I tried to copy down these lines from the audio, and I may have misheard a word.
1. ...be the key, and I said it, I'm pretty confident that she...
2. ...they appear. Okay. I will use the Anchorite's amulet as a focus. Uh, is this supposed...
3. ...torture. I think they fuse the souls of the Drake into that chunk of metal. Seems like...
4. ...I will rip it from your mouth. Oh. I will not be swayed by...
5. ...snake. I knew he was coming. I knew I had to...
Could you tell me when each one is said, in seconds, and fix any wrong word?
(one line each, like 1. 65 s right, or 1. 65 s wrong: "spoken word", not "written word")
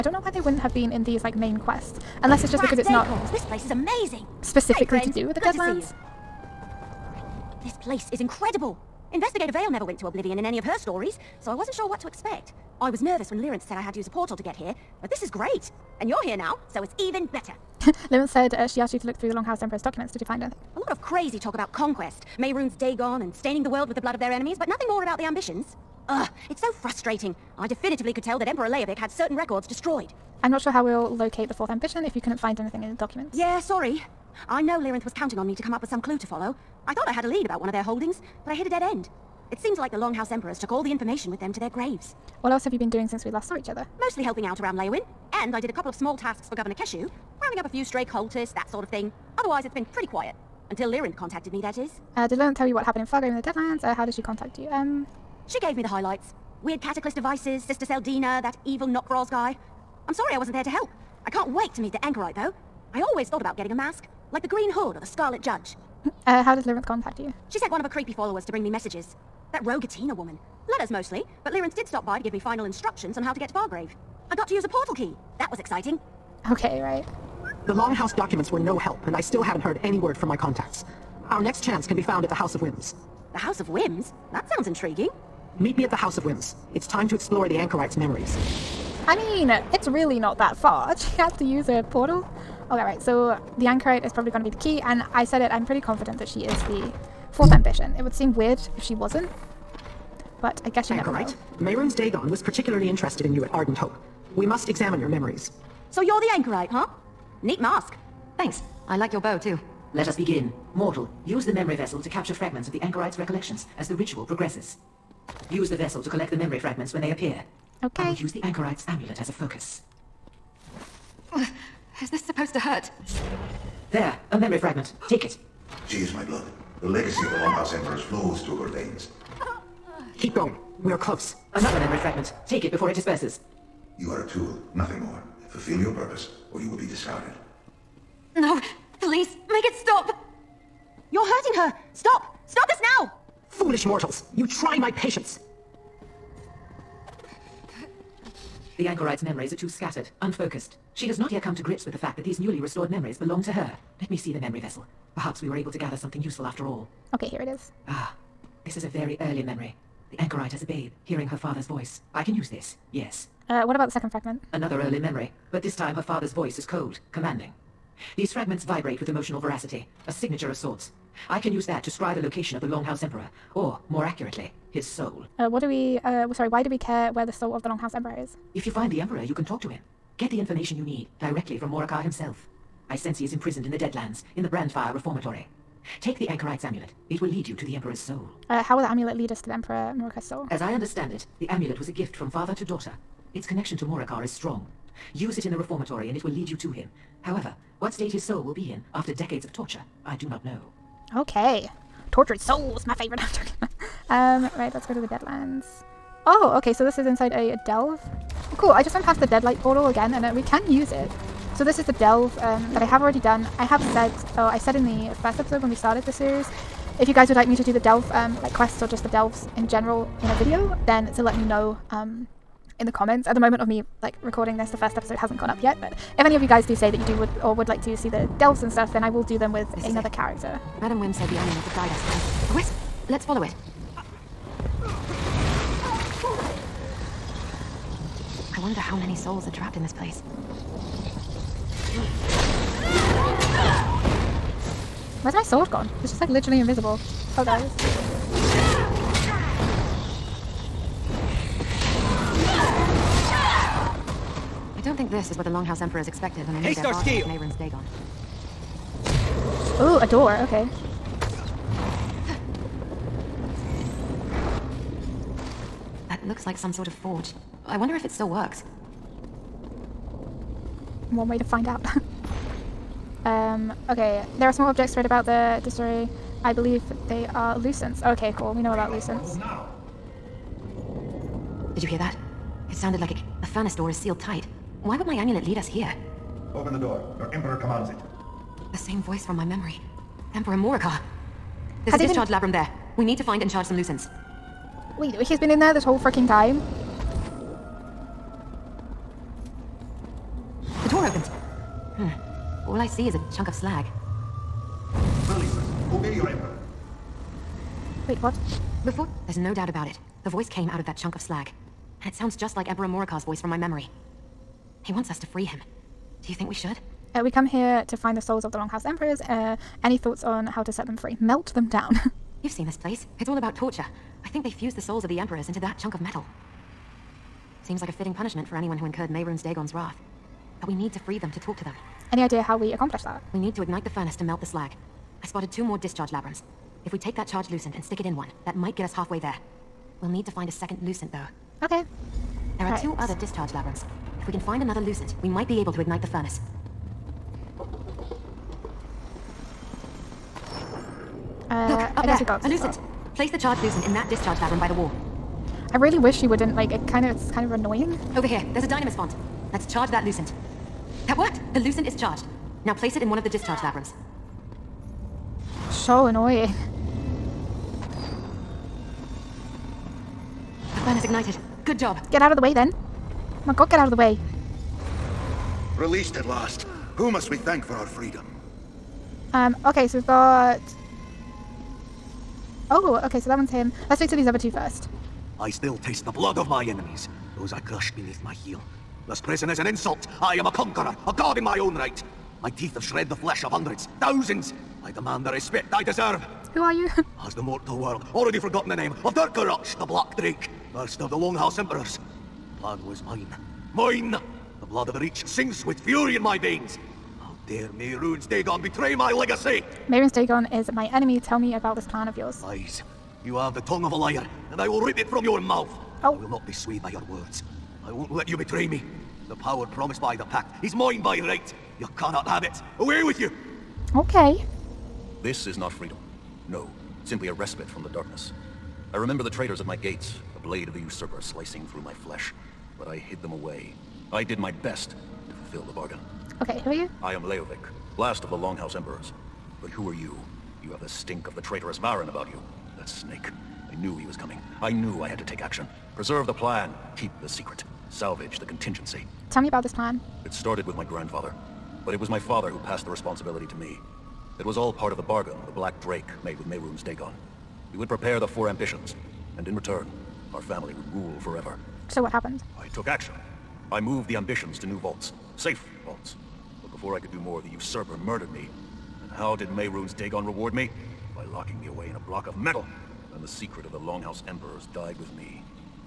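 1. 94 s right
2. 117 s right
3. 323 s wrong: "Emperors", not "Drake"
4. 414 s right
5. 442 s right.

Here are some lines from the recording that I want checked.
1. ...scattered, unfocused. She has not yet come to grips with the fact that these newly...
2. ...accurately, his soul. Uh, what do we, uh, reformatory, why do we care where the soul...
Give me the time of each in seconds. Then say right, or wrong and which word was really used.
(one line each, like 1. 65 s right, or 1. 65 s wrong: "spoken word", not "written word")
1. 149 s right
2. 174 s wrong: "sorry", not "reformatory".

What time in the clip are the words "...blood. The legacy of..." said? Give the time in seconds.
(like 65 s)
126 s.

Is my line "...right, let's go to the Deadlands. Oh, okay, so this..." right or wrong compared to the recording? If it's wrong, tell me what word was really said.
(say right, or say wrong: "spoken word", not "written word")
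right.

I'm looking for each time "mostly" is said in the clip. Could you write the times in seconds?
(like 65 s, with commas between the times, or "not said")
43 s, 70 s.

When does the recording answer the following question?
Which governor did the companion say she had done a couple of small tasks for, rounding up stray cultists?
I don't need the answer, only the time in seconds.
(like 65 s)
46 s.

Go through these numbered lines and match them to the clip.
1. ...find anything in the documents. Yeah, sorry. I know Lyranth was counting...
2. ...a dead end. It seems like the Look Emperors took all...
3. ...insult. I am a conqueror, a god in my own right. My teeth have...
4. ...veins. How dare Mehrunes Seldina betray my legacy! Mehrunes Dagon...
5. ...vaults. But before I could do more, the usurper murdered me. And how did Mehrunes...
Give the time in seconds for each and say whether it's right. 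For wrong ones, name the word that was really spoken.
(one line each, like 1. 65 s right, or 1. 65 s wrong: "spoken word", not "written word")
1. 32 s right
2. 38 s wrong: "Longhouse", not "Look"
3. 389 s right
4. 406 s wrong: "Dagon", not "Seldina"
5. 465 s right.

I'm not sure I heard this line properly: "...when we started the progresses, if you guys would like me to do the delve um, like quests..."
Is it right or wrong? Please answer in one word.
wrong.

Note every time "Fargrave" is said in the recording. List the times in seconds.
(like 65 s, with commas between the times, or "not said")
53 s, 73 s.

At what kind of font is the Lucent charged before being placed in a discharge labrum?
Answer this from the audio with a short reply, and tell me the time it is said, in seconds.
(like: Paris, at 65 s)
dynamis font, at 358 s.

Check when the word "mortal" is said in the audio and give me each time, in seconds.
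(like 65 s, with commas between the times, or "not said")
110 s, 143 s, 397 s.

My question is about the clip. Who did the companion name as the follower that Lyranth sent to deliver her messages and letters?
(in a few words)
Rogatina.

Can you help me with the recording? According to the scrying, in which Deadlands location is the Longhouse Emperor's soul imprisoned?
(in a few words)
Brandfire Reformatory.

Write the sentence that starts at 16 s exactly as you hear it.
And you're here now, so it's even better.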